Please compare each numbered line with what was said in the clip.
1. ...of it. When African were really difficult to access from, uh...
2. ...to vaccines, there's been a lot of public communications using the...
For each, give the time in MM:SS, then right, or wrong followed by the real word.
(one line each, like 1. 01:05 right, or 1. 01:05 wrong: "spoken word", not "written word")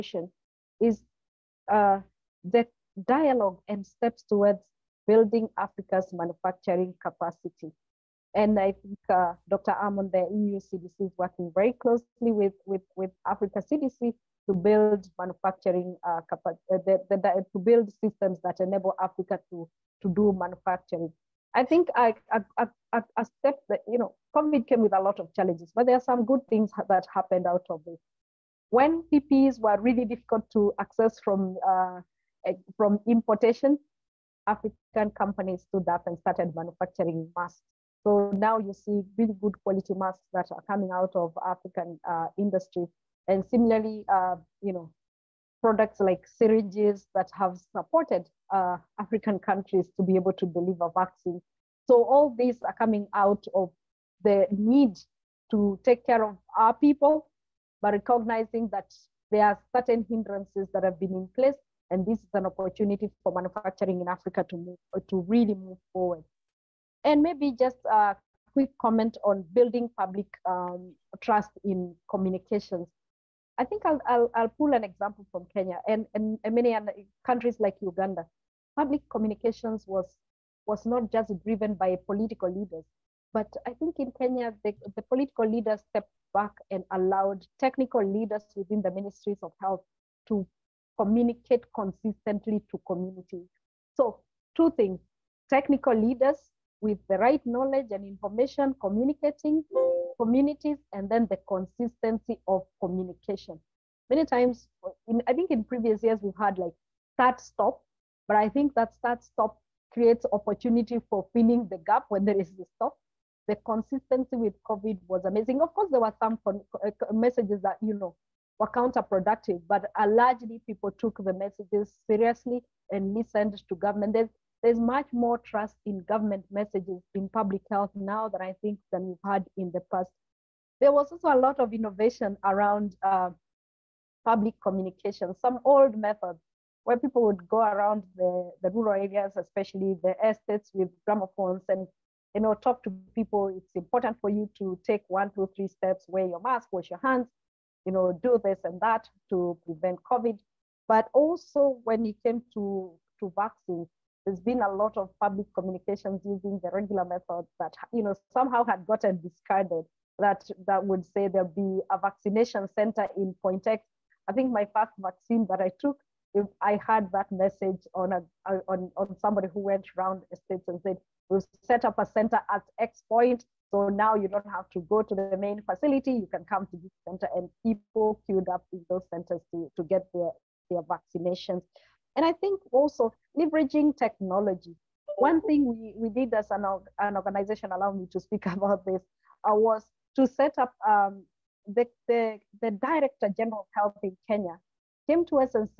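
1. 00:27 wrong: "PPEs", not "African"
2. 02:33 right.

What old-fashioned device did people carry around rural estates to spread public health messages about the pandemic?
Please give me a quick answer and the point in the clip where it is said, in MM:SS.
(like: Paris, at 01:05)
gramophones, at 02:21.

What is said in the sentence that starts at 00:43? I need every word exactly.
And similarly, uh, you know, products like syringes that have supported uh, African countries to be able to deliver vaccines.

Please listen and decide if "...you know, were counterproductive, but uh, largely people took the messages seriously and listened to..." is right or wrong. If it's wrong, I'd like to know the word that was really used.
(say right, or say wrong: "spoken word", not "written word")
right.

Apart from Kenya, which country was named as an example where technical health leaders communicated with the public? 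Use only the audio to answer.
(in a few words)
Uganda.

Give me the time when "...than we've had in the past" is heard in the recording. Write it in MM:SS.
02:08.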